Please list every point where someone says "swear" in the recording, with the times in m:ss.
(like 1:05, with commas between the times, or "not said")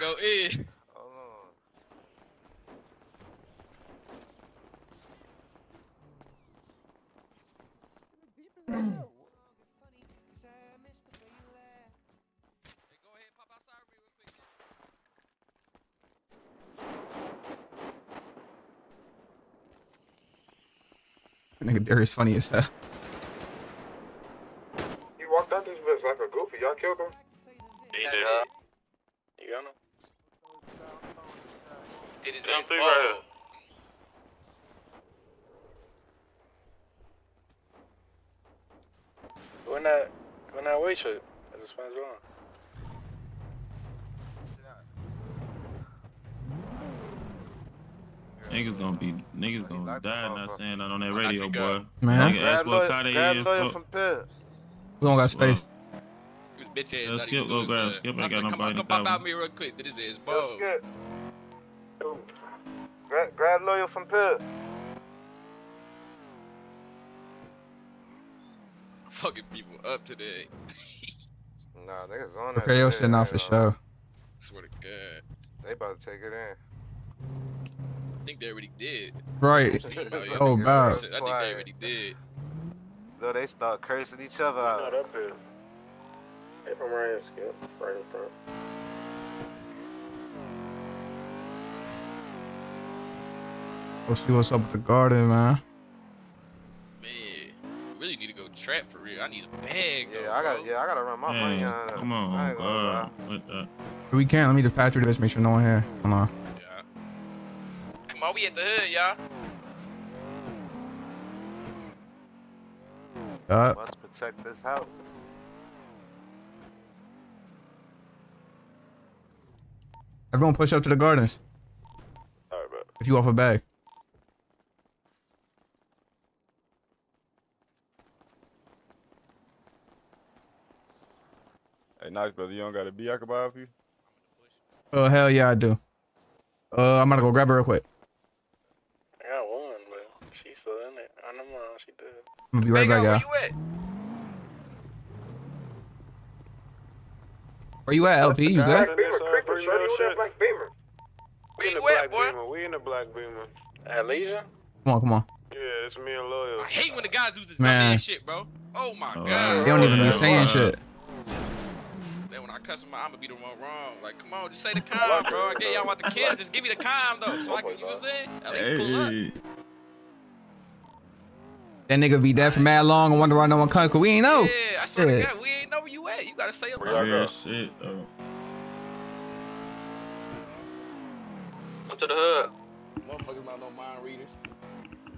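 1:14, 2:54.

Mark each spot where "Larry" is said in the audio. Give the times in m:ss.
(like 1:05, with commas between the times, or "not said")
not said.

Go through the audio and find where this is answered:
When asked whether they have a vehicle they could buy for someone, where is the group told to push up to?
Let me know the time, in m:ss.
2:00.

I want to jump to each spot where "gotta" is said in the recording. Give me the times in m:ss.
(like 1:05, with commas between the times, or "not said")
1:40, 2:56.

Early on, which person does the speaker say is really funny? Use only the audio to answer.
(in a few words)
Darius.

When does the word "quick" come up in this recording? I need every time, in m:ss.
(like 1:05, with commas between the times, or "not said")
0:59, 2:17.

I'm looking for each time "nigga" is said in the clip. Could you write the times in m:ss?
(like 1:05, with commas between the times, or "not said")
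0:21, 0:52, 1:12, 2:51.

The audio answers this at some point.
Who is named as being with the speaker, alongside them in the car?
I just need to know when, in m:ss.
2:36.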